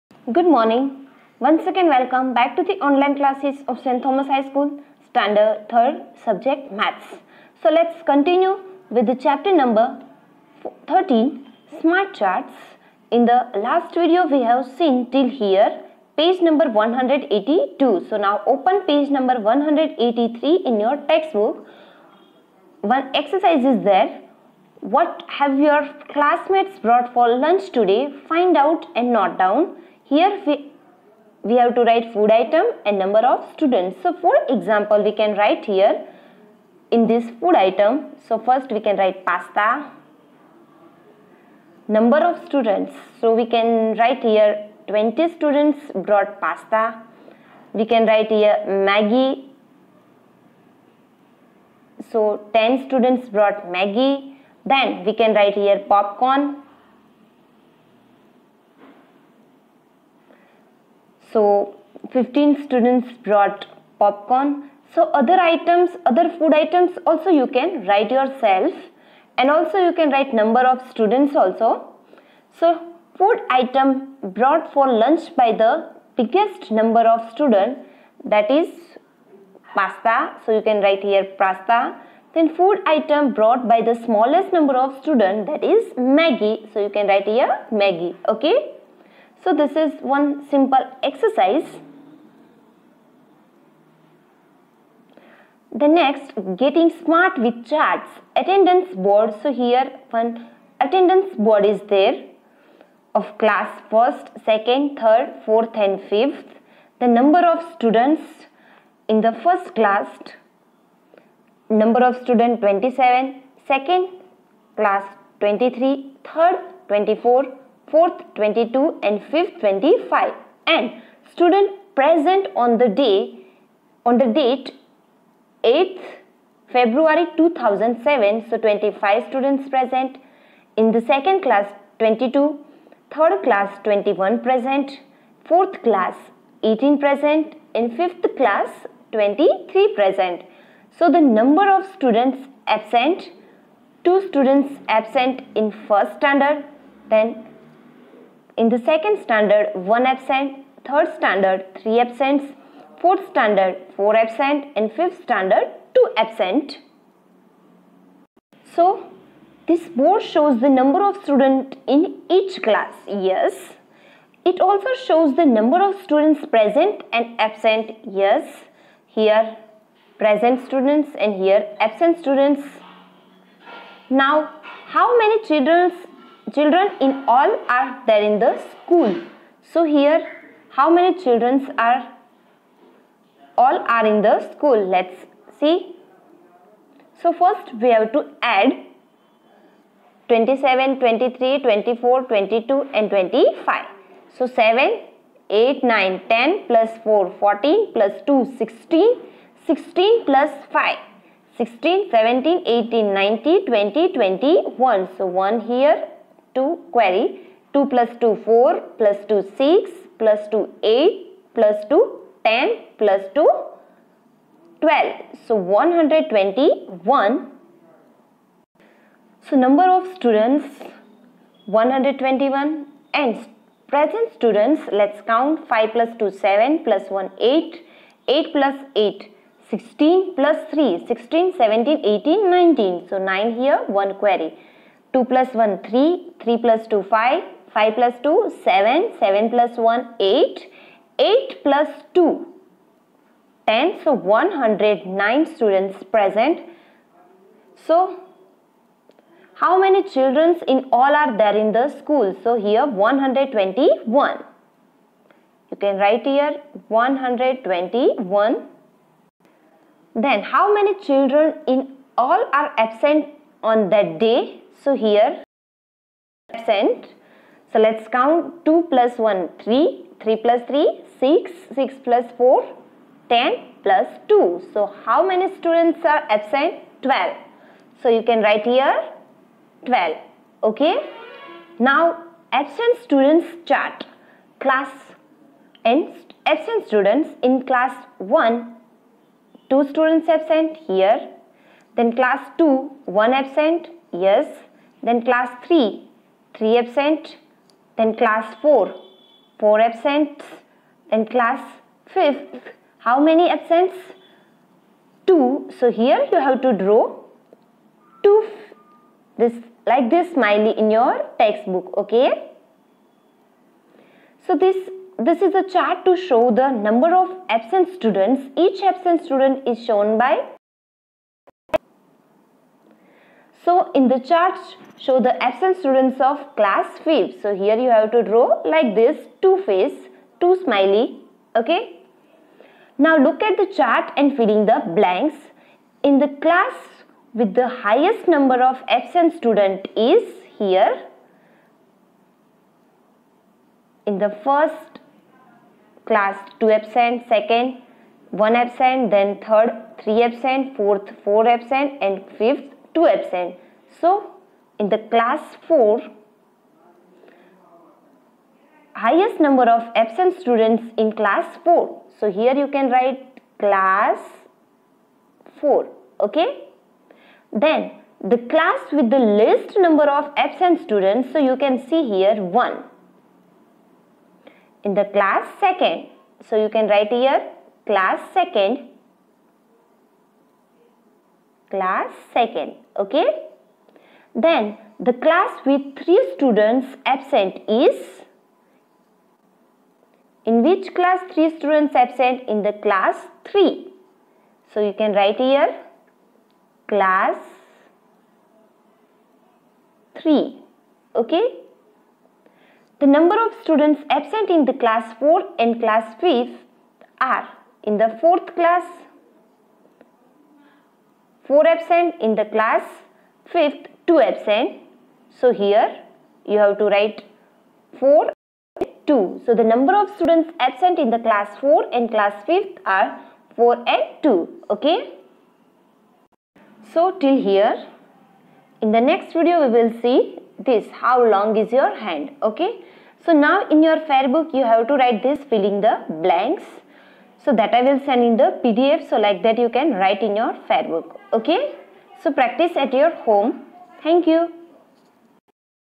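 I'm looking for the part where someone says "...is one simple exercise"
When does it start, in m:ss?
1:29.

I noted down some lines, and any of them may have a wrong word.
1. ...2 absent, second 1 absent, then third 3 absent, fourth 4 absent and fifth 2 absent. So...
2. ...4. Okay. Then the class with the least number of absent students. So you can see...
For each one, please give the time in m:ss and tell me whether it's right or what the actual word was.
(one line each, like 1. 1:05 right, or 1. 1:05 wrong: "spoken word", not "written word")
1. 5:46 right
2. 6:05 right.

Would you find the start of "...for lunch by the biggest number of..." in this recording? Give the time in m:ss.
1:14.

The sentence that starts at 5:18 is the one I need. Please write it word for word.
Each absent student is shown by so in the chart, show the absent students of class five.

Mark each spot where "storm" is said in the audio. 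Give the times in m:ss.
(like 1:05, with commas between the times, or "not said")
not said.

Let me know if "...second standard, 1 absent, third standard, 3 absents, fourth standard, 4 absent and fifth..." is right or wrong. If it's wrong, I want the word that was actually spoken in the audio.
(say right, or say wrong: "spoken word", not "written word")
right.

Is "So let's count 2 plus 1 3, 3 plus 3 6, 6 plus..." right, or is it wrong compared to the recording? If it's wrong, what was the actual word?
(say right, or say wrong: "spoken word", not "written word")
right.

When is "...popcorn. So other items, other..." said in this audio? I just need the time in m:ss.
1:03.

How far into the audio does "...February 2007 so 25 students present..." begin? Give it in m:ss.
2:06.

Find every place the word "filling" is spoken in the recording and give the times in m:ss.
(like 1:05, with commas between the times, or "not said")
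5:34, 7:15.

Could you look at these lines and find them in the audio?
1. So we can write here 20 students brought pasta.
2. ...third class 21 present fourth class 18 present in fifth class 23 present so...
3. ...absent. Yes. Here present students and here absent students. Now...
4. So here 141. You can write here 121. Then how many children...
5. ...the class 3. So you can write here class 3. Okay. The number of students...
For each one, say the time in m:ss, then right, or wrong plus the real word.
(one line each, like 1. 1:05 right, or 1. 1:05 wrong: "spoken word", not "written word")
1. 0:43 right
2. 2:13 right
3. 2:47 right
4. 4:12 wrong: "121", not "141"
5. 6:32 right.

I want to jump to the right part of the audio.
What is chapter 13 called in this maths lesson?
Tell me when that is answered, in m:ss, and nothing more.
0:11.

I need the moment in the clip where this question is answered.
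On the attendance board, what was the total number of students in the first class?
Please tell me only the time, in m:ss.
1:52.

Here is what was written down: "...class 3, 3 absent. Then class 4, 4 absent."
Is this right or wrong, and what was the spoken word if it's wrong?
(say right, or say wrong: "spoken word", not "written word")
right.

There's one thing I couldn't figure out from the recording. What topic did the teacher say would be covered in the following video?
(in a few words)
How long is your hand.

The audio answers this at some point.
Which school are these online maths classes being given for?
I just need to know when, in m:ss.
0:03.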